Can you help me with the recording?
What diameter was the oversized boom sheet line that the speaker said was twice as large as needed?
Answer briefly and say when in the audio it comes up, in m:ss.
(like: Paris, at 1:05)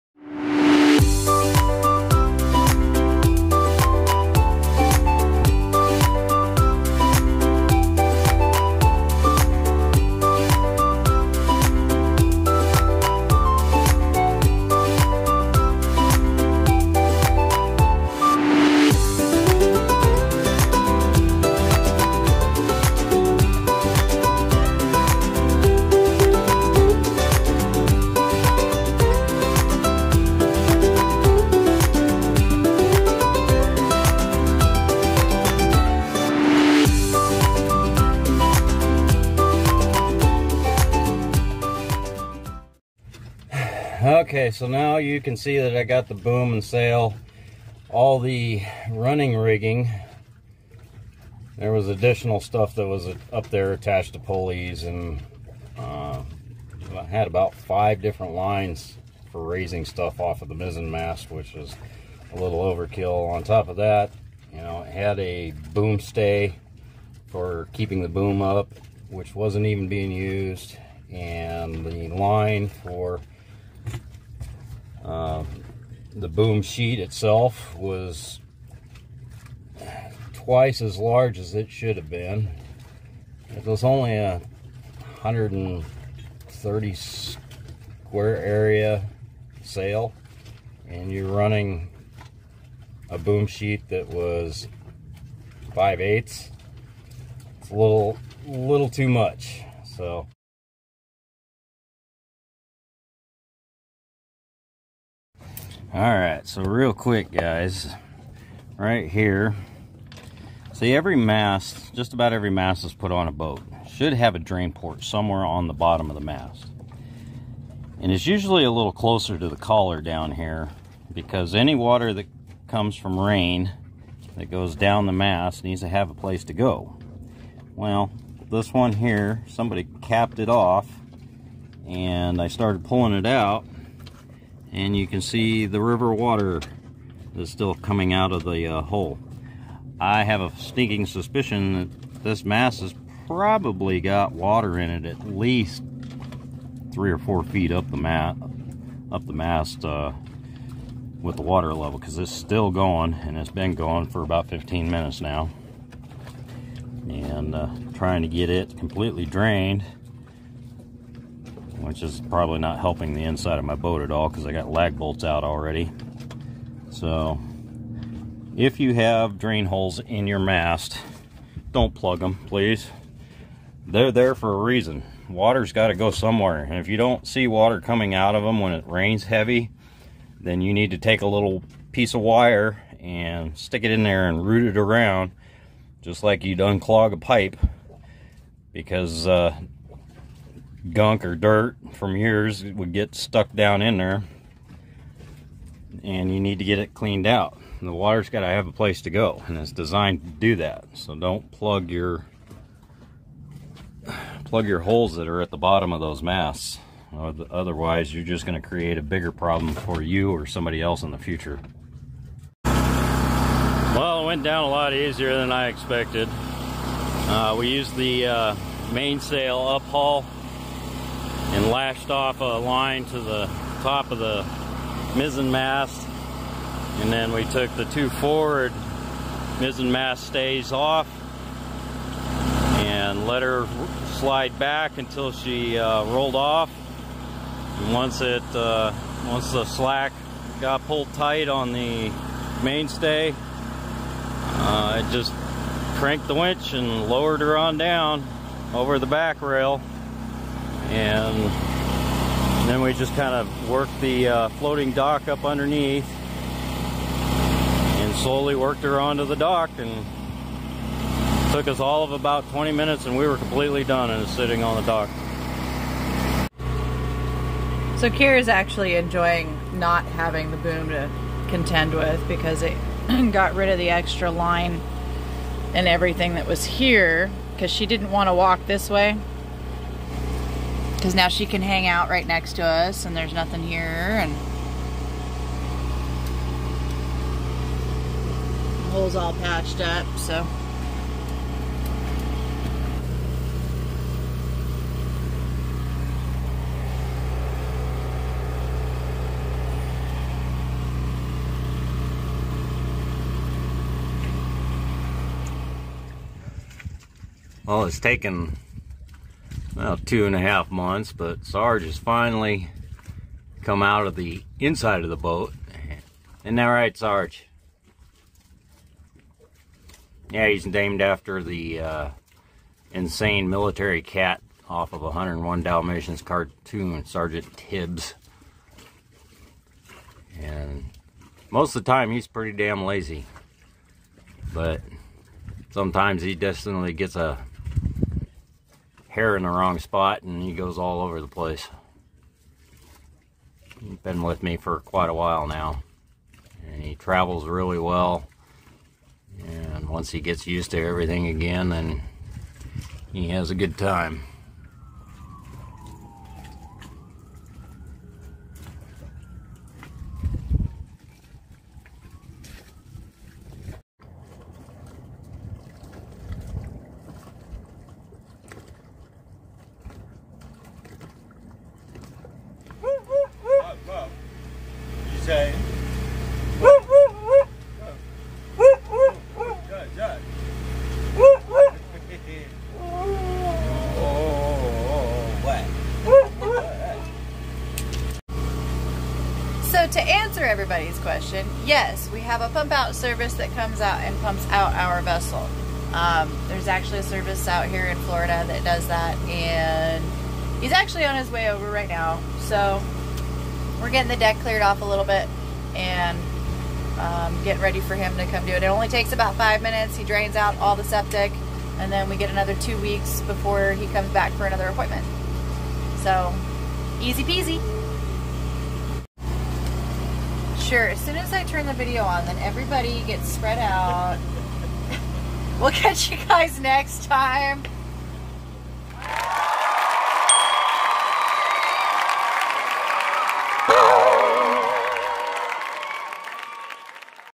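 5/8, at 1:35.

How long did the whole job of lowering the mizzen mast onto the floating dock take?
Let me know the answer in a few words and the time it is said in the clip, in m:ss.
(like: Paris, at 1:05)
20 minutes, at 4:22.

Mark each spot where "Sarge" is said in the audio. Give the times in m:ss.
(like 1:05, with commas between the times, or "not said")
5:11, 5:16.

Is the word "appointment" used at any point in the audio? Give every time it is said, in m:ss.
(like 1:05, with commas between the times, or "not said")
6:54.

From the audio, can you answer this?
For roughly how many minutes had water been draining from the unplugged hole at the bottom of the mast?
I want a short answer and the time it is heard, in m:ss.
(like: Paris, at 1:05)
15 minutes, at 2:34.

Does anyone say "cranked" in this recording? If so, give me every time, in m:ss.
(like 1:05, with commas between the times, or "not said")
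4:05.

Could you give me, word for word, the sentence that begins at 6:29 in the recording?
to answer everybody's question, yes, we have a pump out service that comes out and pumps out our vessel.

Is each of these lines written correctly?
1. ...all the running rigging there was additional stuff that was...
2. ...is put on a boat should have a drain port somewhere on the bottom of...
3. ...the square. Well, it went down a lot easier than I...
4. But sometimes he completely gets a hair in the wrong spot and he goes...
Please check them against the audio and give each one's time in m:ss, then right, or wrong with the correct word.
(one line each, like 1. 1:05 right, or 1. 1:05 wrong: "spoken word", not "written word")
1. 0:47 right
2. 1:52 right
3. 3:31 wrong: "future", not "square"
4. 5:34 wrong: "definitely", not "completely".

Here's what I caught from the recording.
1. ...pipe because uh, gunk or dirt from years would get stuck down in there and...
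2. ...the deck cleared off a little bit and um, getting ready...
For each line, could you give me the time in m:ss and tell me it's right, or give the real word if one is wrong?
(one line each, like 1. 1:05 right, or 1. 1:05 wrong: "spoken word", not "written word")
1. 3:07 right
2. 6:44 right.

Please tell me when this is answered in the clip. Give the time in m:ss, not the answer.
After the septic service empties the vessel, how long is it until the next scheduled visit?
6:52.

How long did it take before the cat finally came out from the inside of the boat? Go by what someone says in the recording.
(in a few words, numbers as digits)
two and a half months.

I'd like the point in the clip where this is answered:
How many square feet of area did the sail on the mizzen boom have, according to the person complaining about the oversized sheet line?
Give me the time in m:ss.
1:25.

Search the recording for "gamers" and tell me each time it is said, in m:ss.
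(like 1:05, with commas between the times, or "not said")
not said.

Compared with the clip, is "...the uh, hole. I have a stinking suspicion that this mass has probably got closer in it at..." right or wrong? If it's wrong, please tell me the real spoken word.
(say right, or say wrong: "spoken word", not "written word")
wrong: "water", not "closer".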